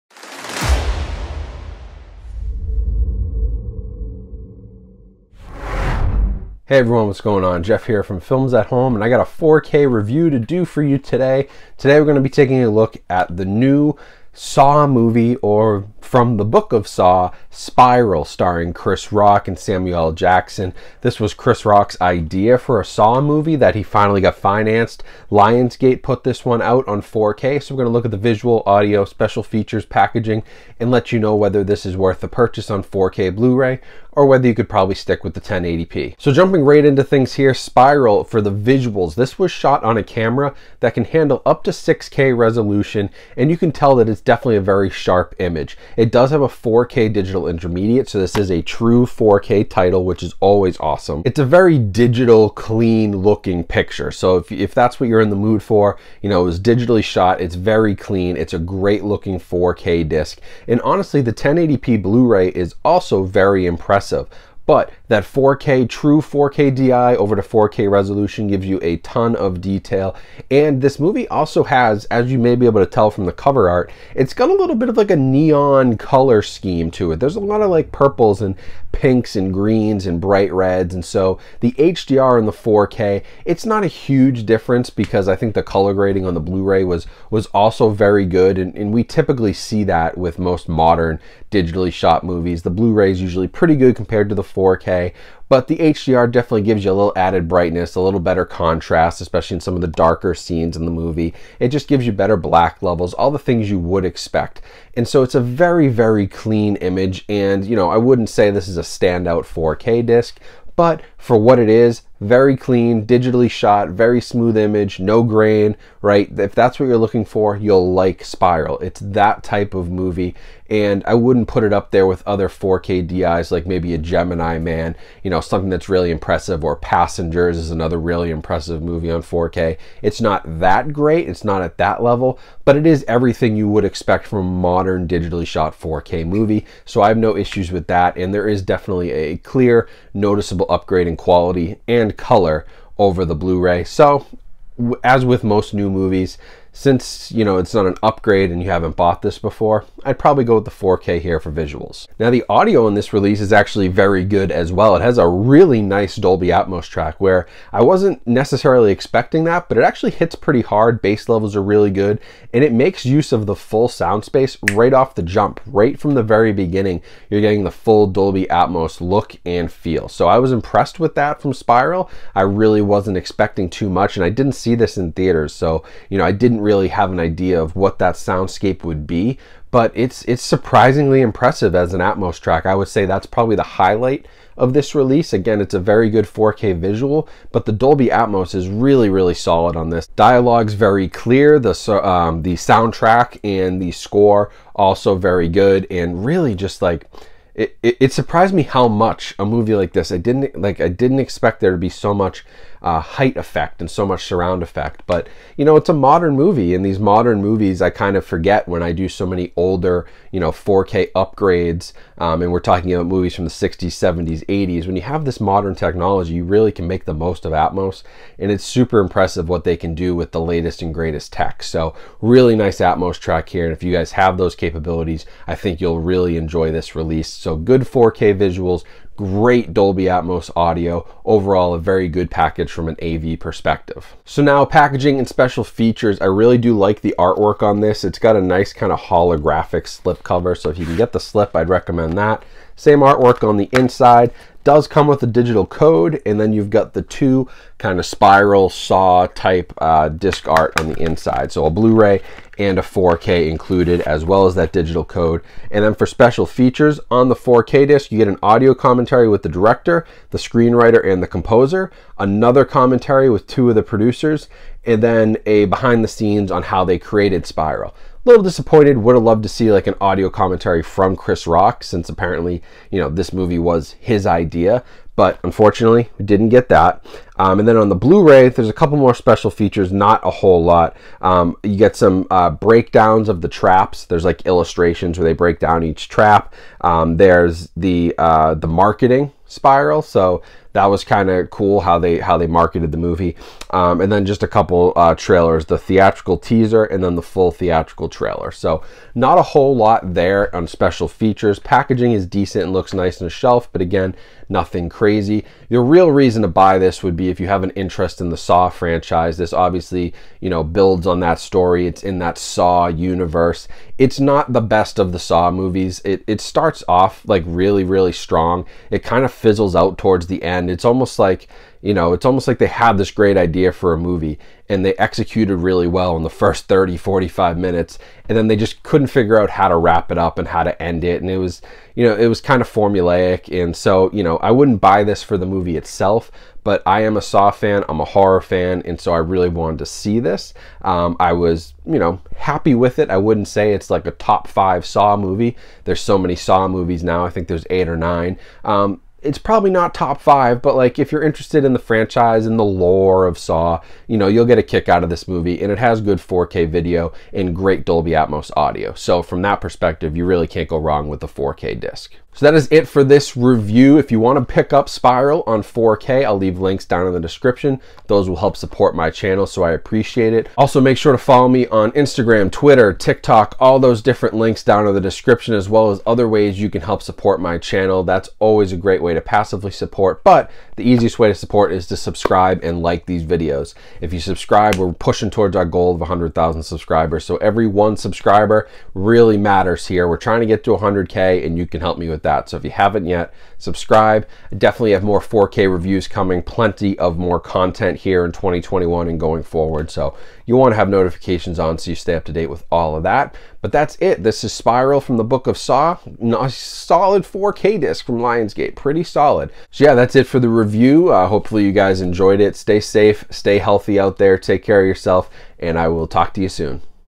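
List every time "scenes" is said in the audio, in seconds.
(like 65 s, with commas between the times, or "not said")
100 s, 266 s.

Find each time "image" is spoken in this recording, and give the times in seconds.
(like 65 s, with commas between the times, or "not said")
45 s, 106 s, 114 s.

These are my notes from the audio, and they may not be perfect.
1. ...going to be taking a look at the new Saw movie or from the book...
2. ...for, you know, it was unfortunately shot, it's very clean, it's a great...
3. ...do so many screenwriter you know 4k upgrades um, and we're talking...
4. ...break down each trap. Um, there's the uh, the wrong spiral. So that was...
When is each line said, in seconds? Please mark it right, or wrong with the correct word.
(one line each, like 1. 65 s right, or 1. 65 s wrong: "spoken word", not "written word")
1. 12 s right
2. 55 s wrong: "digitally", not "unfortunately"
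3. 208 s wrong: "older", not "screenwriter"
4. 285 s wrong: "marketing", not "wrong".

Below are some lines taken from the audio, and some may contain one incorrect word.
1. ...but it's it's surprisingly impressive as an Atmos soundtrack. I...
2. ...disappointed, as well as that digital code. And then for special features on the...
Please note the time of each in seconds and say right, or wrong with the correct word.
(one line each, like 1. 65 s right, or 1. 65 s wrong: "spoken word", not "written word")
1. 179 s wrong: "track", not "soundtrack"
2. 253 s wrong: "included", not "disappointed".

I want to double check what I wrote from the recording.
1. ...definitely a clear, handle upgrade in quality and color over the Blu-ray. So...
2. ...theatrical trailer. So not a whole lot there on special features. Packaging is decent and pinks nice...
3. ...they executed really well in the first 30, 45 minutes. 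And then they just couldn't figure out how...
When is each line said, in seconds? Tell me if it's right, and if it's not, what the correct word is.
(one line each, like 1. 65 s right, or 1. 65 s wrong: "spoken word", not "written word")
1. 138 s wrong: "noticeable", not "handle"
2. 297 s wrong: "looks", not "pinks"
3. 324 s right.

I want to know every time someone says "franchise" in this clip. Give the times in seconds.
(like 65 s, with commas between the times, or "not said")
308 s, 351 s.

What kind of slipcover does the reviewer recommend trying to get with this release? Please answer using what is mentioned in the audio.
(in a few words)
Holographic.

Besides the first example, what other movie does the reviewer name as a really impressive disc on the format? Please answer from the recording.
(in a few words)
Passengers.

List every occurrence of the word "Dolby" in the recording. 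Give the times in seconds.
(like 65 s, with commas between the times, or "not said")
156 s, 168 s, 187 s, 229 s, 357 s.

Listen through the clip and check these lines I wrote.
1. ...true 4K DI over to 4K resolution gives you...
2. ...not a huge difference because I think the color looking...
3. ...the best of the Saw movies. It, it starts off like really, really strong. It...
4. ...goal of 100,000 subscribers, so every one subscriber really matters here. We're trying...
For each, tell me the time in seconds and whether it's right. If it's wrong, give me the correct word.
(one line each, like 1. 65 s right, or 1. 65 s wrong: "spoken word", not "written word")
1. 65 s right
2. 83 s wrong: "grading", not "looking"
3. 314 s right
4. 385 s right.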